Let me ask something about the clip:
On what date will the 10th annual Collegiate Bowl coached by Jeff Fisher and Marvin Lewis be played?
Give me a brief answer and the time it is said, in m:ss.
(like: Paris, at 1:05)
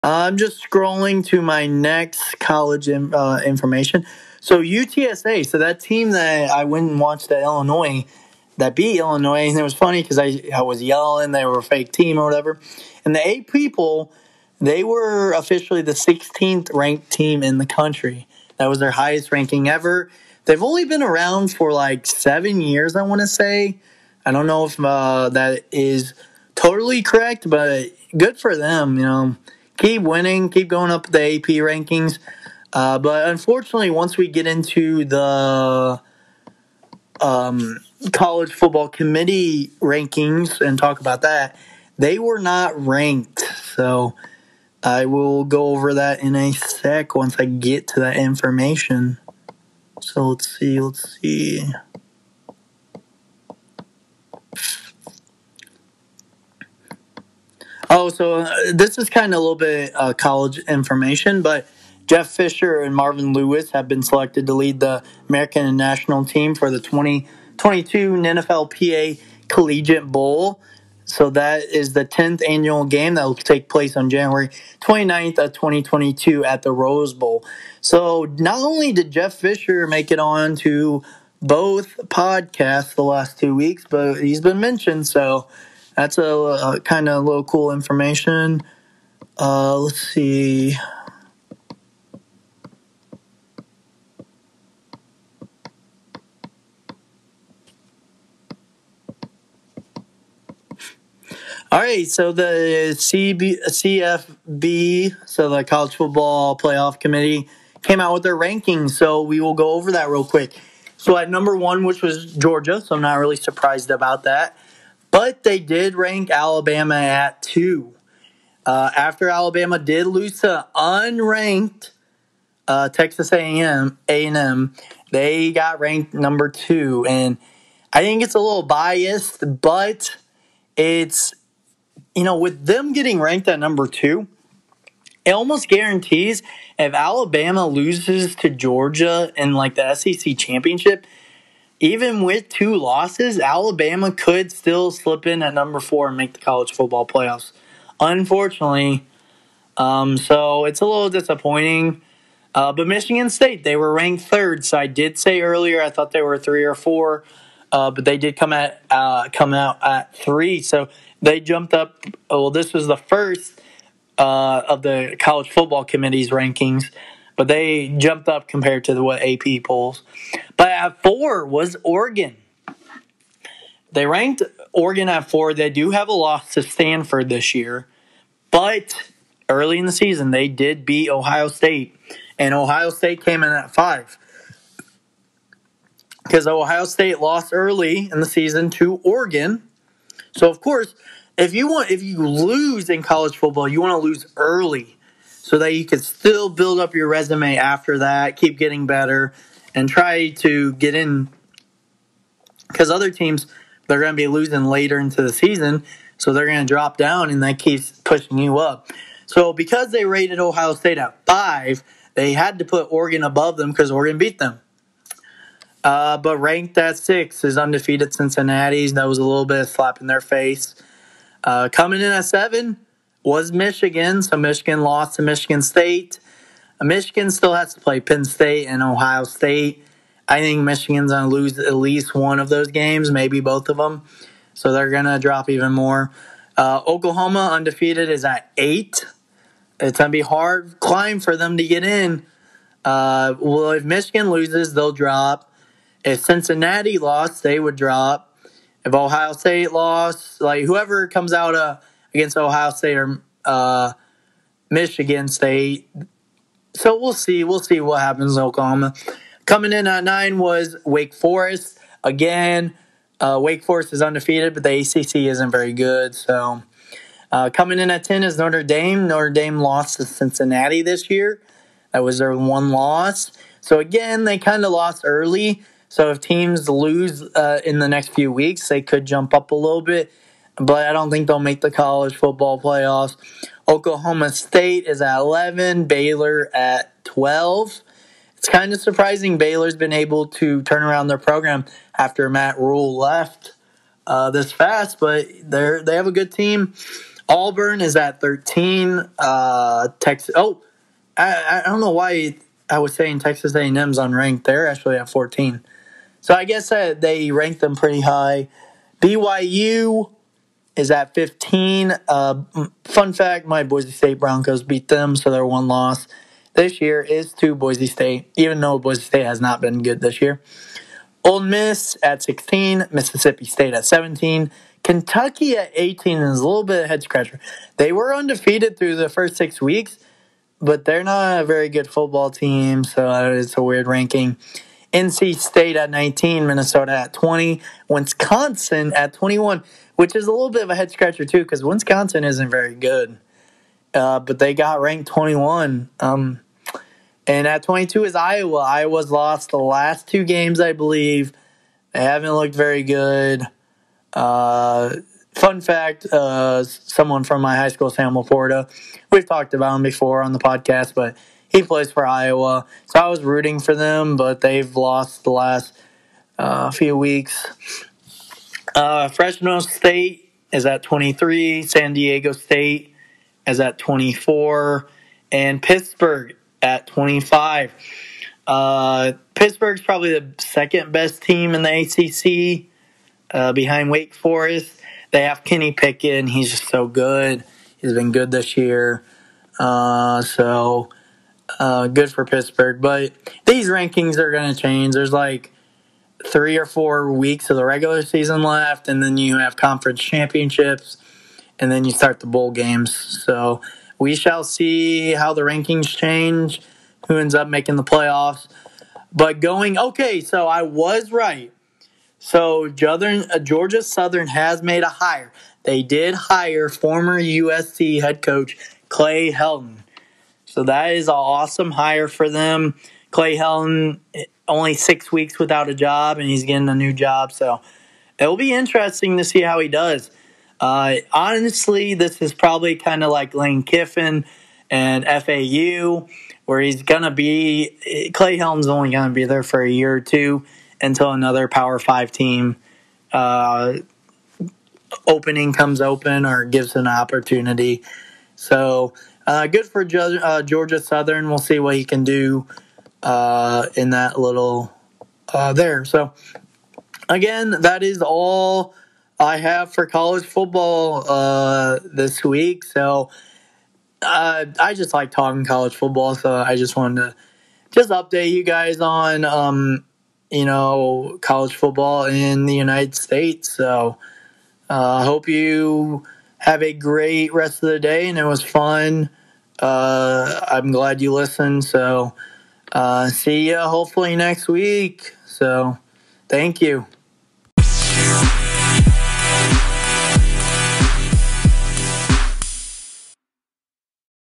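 January 29th, 2022, at 1:14.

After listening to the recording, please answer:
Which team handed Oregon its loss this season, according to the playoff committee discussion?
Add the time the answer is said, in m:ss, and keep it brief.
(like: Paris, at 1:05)
Stanford, at 2:56.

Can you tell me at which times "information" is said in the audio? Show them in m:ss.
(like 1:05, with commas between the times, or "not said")
0:03, 0:48, 1:00, 1:27.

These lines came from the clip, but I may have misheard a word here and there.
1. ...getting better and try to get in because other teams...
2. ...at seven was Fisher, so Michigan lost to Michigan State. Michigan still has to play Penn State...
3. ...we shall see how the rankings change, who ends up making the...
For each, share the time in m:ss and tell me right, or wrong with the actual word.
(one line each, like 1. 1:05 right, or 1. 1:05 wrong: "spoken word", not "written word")
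1. 3:18 right
2. 3:42 wrong: "Michigan", not "Fisher"
3. 6:43 right.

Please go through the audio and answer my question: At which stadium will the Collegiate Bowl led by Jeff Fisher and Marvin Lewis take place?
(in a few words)
Rose Bowl.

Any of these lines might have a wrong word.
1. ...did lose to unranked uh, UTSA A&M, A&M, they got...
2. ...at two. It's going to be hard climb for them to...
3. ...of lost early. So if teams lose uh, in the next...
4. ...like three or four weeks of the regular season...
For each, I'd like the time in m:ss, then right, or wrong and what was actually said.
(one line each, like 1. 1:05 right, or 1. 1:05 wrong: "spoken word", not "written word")
1. 1:59 wrong: "Texas", not "UTSA"
2. 3:58 wrong: "eight", not "two"
3. 4:34 right
4. 6:35 right.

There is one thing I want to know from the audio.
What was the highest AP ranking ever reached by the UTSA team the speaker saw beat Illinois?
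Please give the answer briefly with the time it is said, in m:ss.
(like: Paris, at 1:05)
16th, at 0:15.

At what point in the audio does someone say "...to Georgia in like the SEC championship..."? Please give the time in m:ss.
2:18.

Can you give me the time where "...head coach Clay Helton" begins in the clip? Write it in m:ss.
6:57.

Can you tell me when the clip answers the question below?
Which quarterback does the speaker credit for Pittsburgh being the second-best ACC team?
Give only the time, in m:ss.
6:25.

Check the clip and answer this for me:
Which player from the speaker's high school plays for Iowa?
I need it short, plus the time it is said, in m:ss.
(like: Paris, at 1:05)
Sam LaPorta, at 5:57.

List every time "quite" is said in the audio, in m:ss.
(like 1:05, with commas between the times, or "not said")
not said.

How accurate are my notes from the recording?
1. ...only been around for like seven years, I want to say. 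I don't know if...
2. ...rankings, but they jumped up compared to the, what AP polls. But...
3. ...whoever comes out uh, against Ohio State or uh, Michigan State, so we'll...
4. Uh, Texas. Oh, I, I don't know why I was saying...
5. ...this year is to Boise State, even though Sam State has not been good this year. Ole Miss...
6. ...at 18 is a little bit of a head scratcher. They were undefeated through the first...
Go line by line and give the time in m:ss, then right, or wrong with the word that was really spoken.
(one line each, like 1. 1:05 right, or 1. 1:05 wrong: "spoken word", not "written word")
1. 0:20 right
2. 2:46 right
3. 4:10 right
4. 4:59 right
5. 5:16 wrong: "Boise", not "Sam"
6. 5:25 right.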